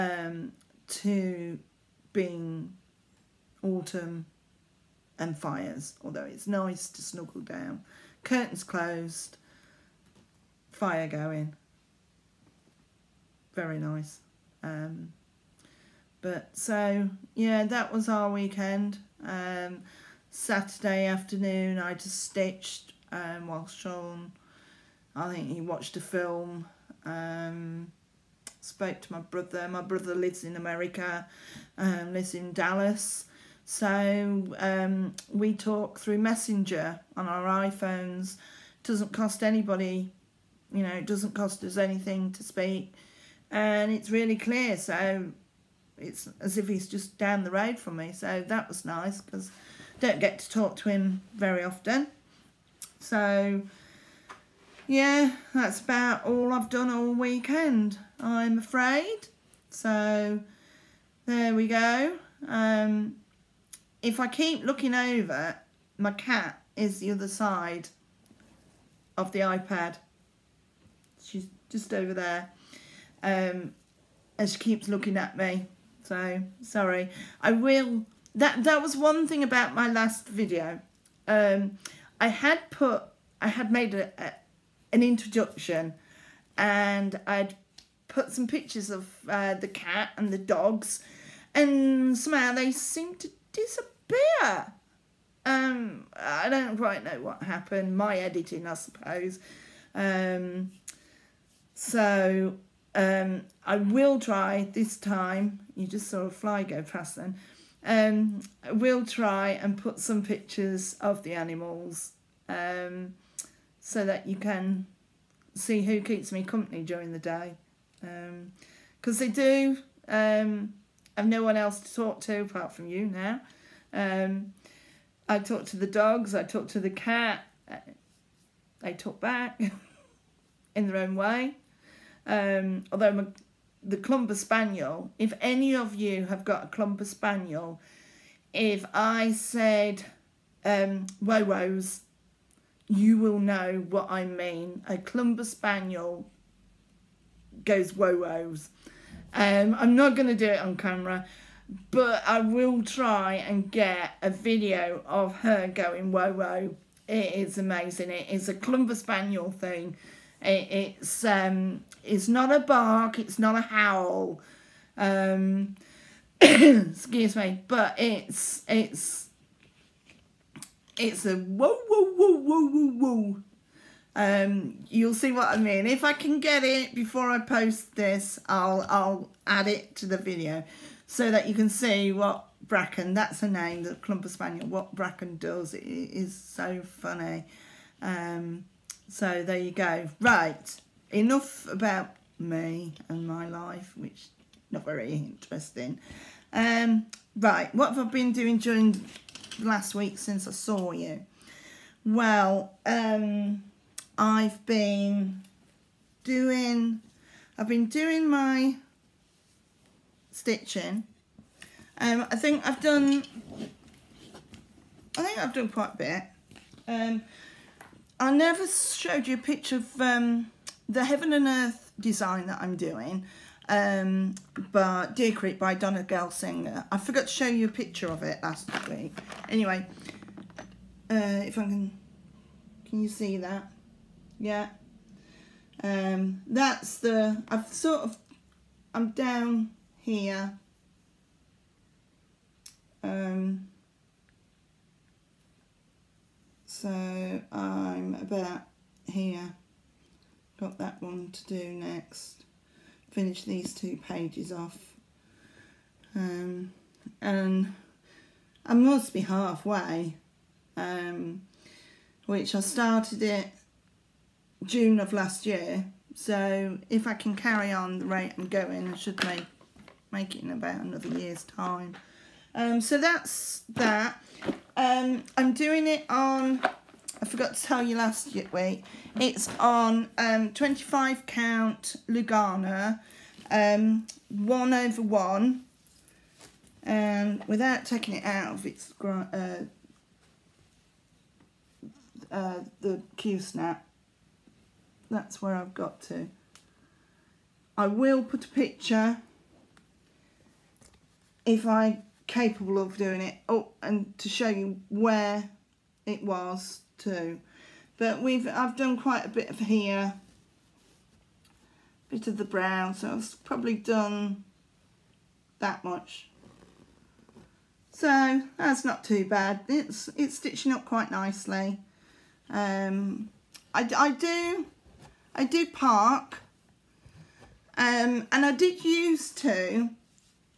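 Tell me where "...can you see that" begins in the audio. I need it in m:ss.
3:52.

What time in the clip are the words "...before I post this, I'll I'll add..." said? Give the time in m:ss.
2:56.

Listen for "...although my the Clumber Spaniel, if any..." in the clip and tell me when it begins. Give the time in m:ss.
2:12.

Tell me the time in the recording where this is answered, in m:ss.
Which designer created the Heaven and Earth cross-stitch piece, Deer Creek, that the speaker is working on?
3:45.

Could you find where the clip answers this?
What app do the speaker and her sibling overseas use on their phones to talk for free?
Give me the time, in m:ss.
0:36.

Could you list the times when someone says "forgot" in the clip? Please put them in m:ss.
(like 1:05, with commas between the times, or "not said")
3:46, 4:37.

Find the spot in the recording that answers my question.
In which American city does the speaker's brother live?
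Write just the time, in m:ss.
0:32.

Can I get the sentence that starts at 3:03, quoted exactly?
That's a name, the Clumber spaniel.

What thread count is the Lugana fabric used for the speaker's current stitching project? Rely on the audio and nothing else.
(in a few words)
25.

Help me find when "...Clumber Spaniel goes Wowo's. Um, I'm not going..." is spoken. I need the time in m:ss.
2:24.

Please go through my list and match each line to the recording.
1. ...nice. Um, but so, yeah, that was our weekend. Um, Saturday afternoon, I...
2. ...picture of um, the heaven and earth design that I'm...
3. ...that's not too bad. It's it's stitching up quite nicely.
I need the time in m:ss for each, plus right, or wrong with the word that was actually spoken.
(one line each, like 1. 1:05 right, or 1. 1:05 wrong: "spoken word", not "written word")
1. 0:13 right
2. 3:39 right
3. 5:18 right.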